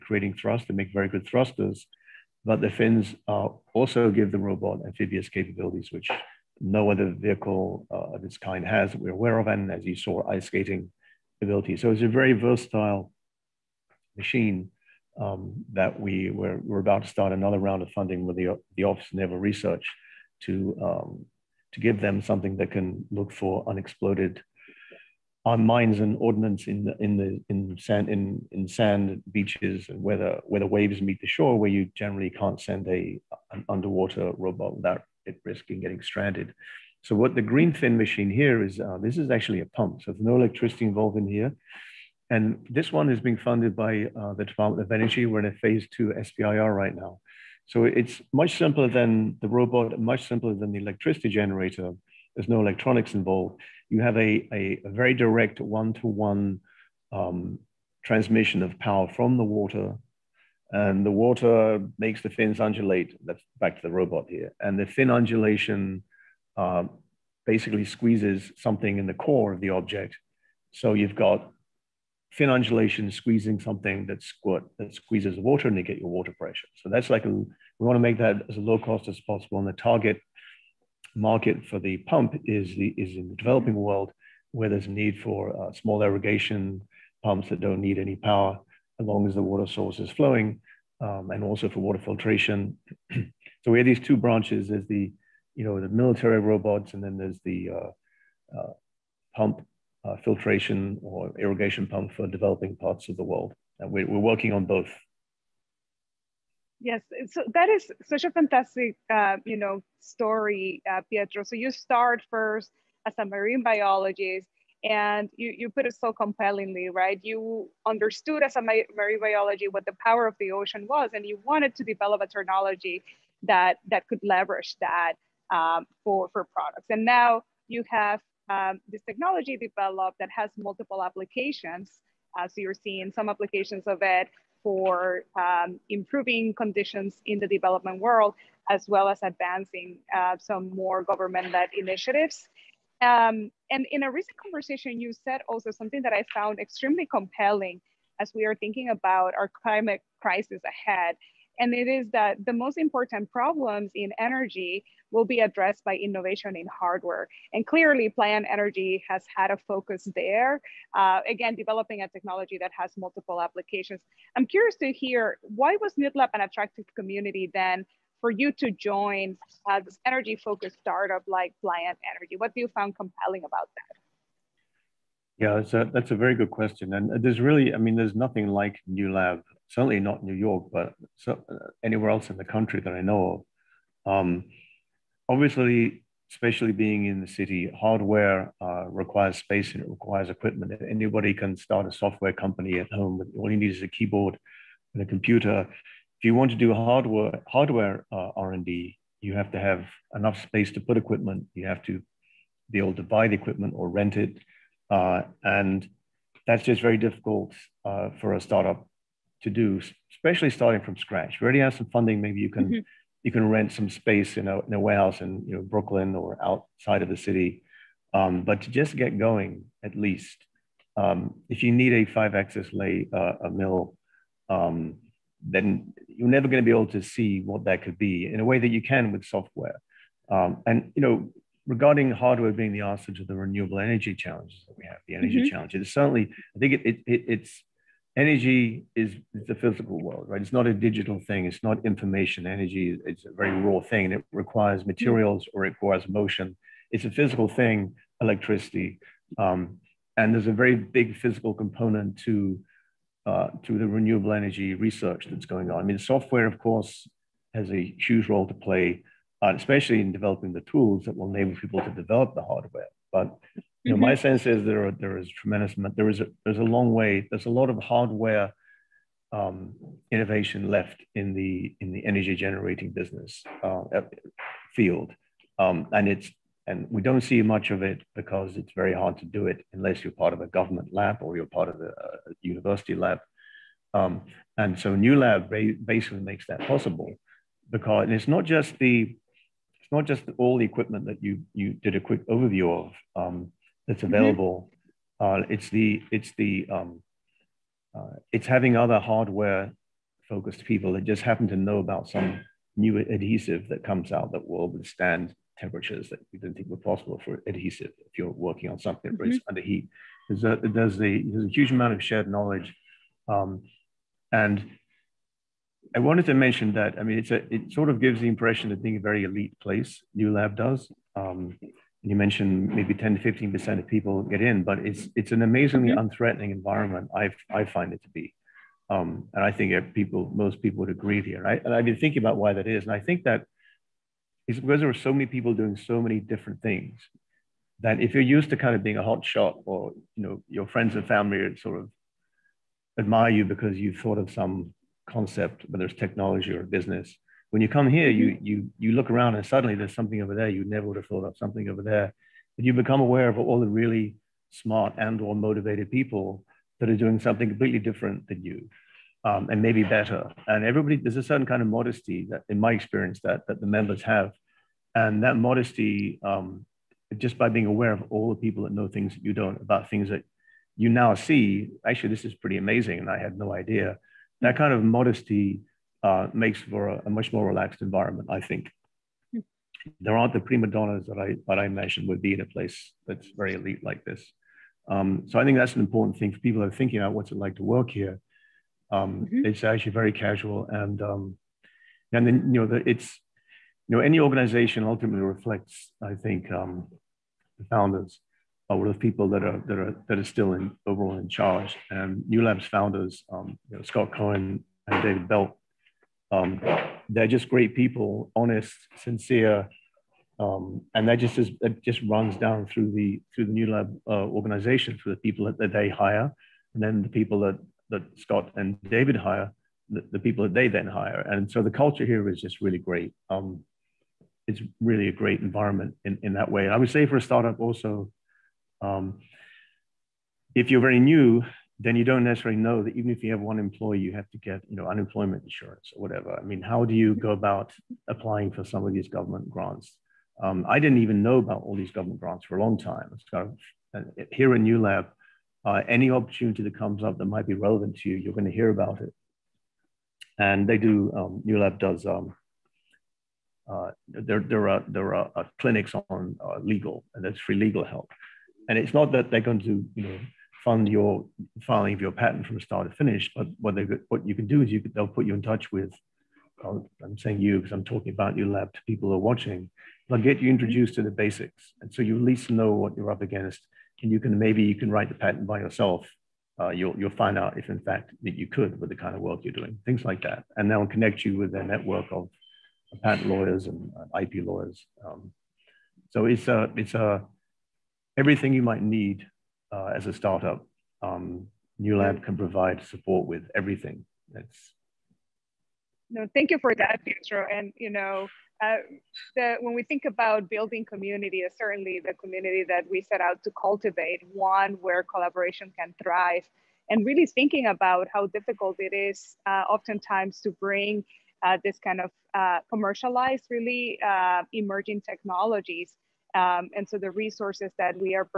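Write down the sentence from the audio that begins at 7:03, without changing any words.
Um, it's really a great environment in, in that way.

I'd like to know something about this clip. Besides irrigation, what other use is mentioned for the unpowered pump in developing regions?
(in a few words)
water filtration.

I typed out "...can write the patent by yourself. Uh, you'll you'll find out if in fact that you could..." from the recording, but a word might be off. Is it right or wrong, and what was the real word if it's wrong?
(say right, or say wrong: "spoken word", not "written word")
right.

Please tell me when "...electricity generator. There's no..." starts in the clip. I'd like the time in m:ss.
0:50.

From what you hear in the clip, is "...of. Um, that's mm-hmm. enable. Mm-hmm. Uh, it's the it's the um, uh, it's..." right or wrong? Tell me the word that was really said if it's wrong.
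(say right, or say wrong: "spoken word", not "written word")
wrong: "available", not "enable".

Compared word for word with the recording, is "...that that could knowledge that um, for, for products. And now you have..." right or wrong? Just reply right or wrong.
wrong.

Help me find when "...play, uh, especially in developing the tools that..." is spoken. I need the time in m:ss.
4:18.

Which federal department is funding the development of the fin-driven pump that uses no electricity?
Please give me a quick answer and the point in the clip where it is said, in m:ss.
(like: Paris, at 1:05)
Department of Energy, at 0:44.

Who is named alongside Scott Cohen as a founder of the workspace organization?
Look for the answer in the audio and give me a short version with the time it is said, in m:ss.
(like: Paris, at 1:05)
David Belt, at 6:45.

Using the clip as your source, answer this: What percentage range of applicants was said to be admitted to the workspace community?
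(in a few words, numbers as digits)
10 to 15 percent.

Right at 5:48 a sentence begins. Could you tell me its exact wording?
you you look around and suddenly there's something over there you never would have thought of, something over there.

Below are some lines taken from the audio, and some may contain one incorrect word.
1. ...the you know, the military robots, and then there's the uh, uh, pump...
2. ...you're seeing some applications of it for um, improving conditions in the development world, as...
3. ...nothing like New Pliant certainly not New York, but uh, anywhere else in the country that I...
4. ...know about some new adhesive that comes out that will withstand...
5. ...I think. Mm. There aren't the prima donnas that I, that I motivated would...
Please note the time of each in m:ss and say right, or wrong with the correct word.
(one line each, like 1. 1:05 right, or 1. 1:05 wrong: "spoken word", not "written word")
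1. 1:34 right
2. 2:12 right
3. 2:58 wrong: "Lab", not "Pliant"
4. 5:01 right
5. 6:18 wrong: "mentioned", not "motivated".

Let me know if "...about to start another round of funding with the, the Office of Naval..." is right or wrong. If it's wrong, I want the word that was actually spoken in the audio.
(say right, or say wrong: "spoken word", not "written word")
right.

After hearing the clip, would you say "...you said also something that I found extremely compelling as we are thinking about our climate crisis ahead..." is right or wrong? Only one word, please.
right.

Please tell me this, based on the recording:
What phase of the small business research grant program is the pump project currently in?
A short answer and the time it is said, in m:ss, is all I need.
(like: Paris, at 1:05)
phase two, at 0:45.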